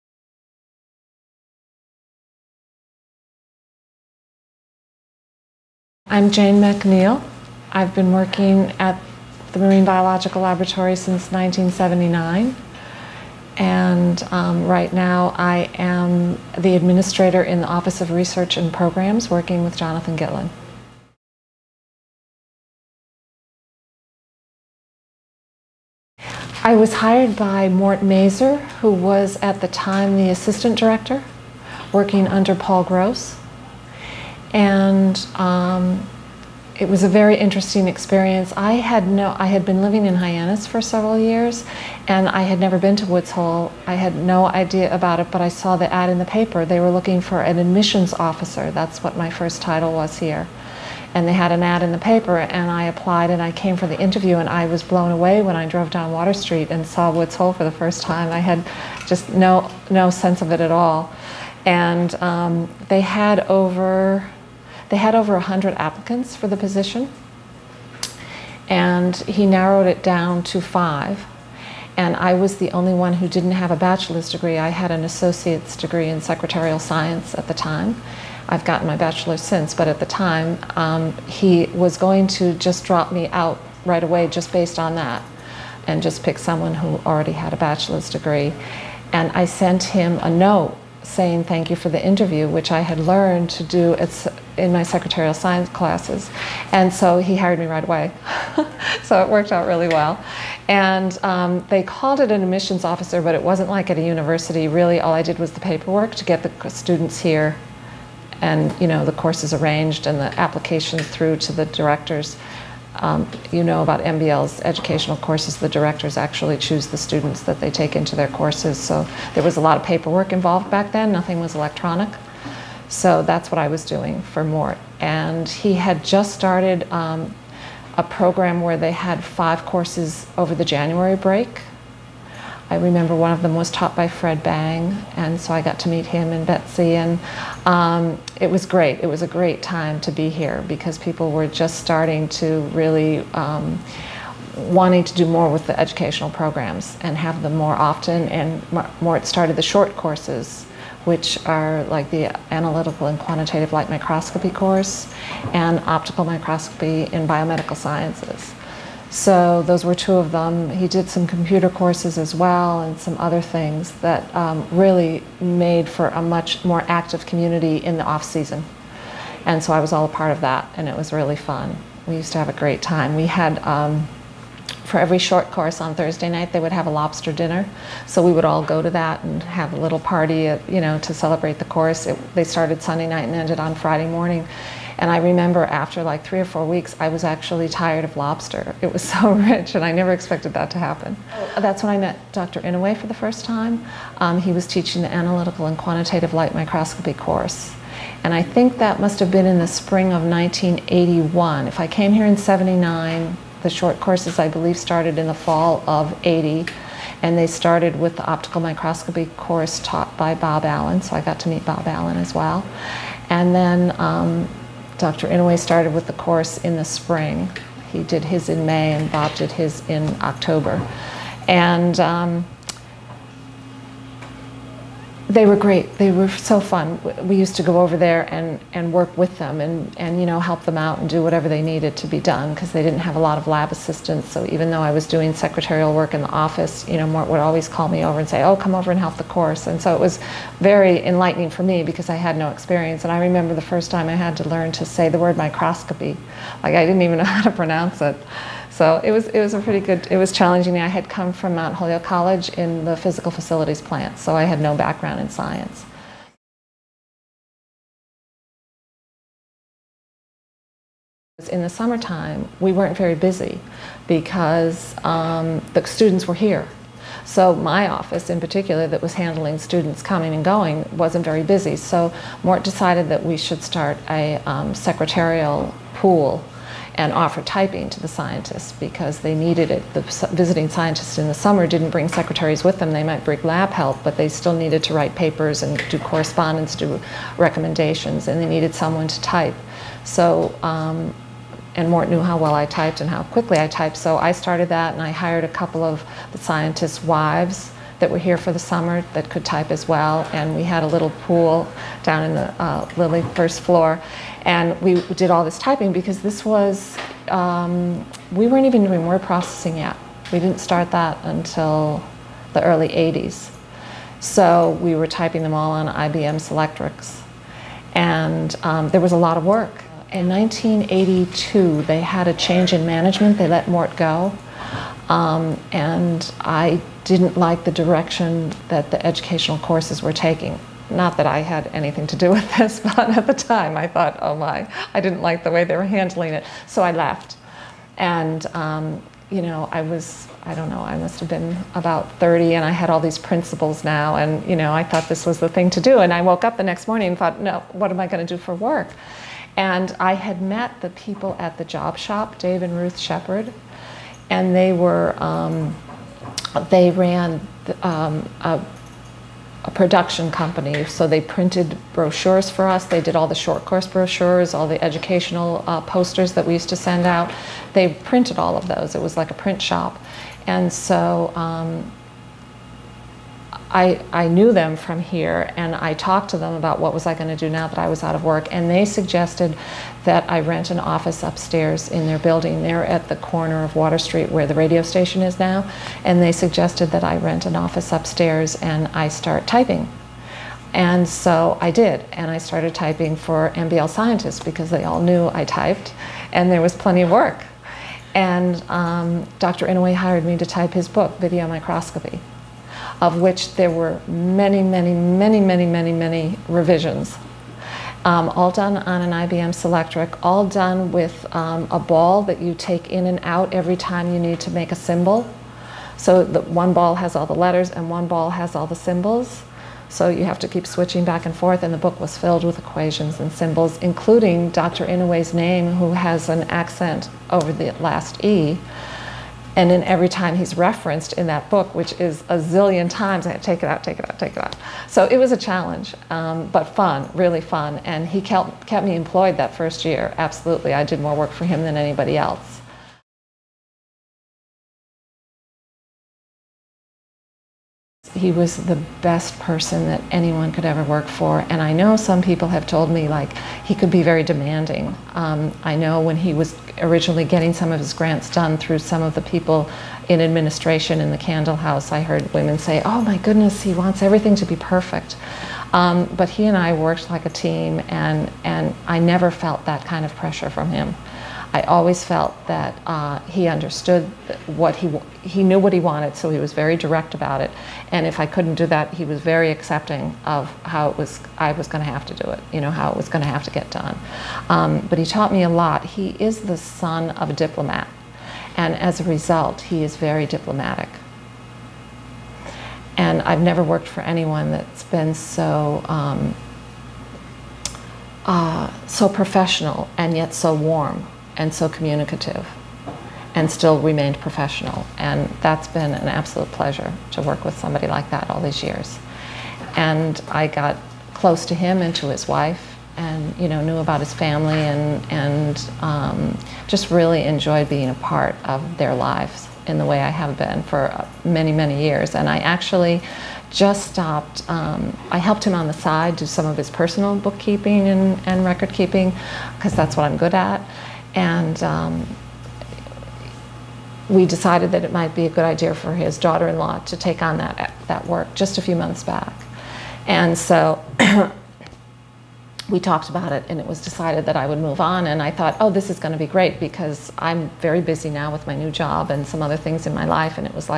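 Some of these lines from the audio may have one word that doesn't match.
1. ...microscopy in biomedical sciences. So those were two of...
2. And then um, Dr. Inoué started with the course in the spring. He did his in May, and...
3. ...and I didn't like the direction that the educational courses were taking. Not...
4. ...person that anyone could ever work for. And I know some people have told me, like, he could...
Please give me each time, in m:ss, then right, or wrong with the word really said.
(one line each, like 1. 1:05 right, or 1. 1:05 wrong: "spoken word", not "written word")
1. 2:36 right
2. 3:33 right
3. 5:25 right
4. 7:29 right.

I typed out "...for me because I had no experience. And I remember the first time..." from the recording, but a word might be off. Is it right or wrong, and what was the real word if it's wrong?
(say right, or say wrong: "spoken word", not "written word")
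right.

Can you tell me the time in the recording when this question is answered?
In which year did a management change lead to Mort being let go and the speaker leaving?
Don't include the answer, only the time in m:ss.
5:20.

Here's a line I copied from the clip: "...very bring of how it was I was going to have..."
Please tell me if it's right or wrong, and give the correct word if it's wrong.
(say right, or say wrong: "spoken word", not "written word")
wrong: "accepting", not "bring".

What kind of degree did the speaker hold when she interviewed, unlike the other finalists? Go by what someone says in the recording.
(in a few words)
Associate's degree.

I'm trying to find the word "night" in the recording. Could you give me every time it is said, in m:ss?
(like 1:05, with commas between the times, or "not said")
2:56, 3:03.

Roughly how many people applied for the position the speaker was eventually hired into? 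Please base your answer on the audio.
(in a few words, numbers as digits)
Over 100.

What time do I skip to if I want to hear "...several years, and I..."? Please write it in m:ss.
0:40.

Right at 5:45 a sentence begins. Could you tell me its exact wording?
And I woke up the next morning and thought, no, what am I going to do for work?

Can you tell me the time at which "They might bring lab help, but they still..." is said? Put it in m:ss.
4:42.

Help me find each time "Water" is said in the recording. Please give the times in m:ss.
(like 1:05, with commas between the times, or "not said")
0:56, 6:23.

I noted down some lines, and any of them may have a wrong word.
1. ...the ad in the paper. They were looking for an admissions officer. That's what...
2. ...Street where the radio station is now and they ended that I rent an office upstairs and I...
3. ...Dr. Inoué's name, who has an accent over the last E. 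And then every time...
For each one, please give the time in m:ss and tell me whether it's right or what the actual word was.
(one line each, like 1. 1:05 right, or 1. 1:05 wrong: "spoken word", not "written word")
1. 0:45 right
2. 6:23 wrong: "suggested", not "ended"
3. 7:04 right.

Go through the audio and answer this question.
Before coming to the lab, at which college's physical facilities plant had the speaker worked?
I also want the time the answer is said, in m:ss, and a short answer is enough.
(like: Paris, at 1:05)
Mount Holyoke College, at 4:11.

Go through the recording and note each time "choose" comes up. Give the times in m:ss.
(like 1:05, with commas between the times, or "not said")
1:56.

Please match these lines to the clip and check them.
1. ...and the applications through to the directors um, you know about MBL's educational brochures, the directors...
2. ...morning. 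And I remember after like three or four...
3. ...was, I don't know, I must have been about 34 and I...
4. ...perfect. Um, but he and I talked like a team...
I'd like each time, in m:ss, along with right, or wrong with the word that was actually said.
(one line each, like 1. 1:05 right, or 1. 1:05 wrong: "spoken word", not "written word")
1. 1:50 wrong: "courses", not "brochures"
2. 3:04 right
3. 5:39 wrong: "30", not "34"
4. 7:44 wrong: "worked", not "talked".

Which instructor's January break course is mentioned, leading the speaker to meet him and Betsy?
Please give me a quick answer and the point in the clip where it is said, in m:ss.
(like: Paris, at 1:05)
Fred Bang, at 2:14.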